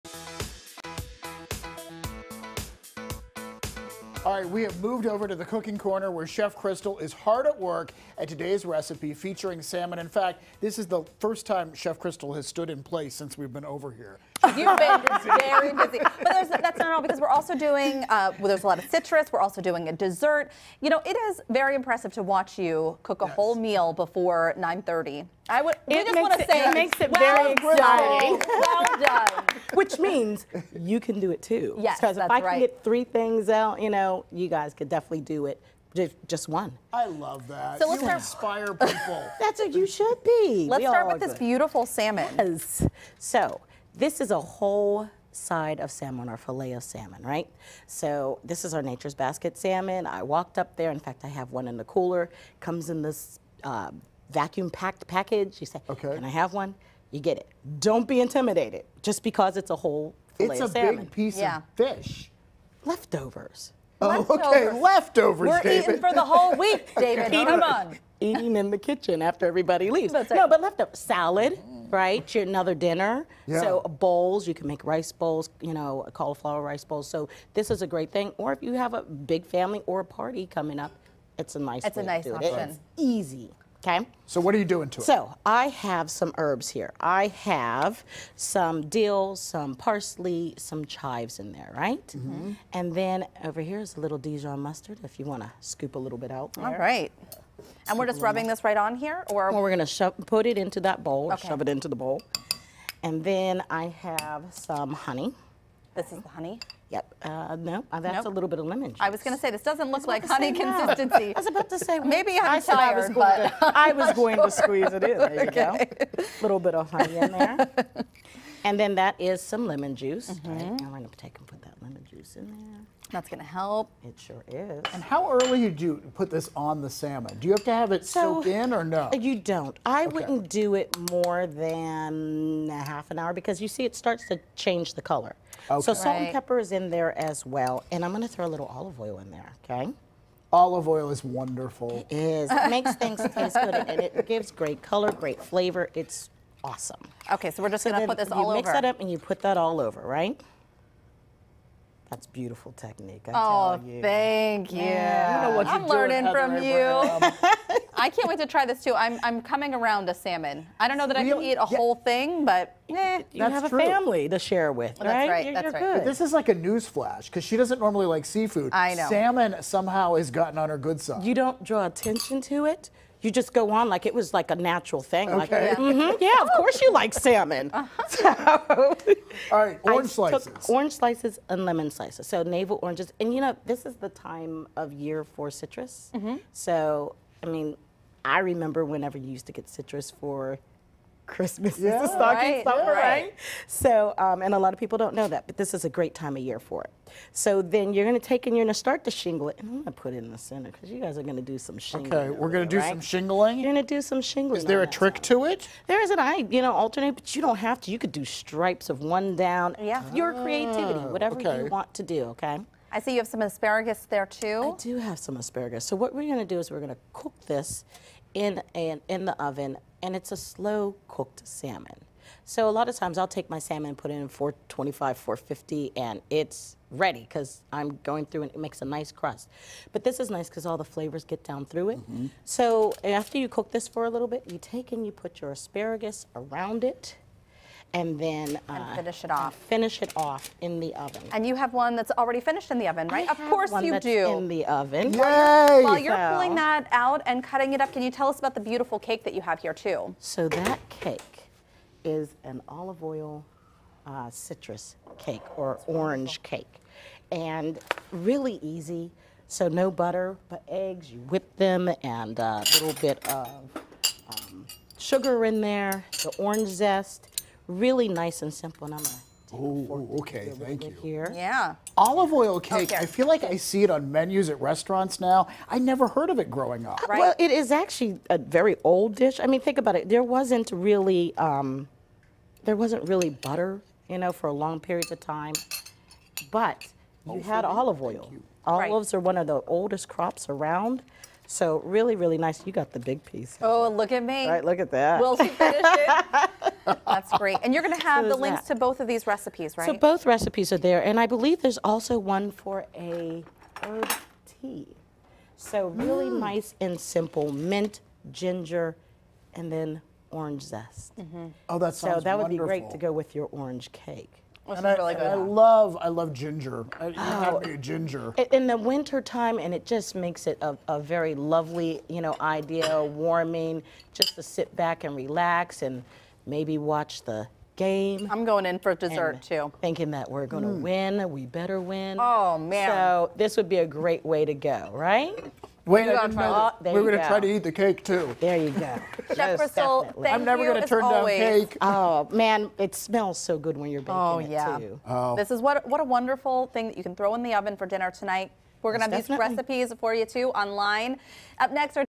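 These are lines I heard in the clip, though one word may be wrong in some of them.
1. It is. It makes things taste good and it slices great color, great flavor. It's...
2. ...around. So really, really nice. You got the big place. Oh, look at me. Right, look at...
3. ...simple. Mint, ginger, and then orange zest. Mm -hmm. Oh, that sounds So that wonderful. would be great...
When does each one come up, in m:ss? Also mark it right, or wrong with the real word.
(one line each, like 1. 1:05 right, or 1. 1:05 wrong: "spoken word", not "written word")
1. 2:21 wrong: "gives", not "slices"
2. 4:50 wrong: "piece", not "place"
3. 5:06 right.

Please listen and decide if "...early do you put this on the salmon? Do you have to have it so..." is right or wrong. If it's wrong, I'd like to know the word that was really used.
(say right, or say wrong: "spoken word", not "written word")
right.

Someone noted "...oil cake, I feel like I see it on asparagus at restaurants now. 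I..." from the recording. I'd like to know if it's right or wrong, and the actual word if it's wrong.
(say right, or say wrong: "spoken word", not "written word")
wrong: "menus", not "asparagus".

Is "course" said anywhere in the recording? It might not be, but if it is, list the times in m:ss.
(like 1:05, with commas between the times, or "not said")
2:56, 4:03.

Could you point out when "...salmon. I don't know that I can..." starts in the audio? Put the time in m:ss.
2:40.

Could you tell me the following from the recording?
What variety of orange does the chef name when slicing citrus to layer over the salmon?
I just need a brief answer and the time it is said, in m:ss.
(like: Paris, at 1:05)
navel, at 3:02.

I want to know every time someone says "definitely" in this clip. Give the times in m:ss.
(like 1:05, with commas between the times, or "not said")
0:34.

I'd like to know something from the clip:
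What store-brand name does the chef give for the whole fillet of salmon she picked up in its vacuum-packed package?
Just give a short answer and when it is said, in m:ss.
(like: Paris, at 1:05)
Nature's Basket, at 0:48.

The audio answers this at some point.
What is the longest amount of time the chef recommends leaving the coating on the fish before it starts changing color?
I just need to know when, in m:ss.
2:12.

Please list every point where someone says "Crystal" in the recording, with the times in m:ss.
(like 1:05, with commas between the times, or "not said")
0:06, 0:11.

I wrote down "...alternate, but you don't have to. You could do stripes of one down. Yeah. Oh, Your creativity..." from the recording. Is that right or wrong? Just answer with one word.
right.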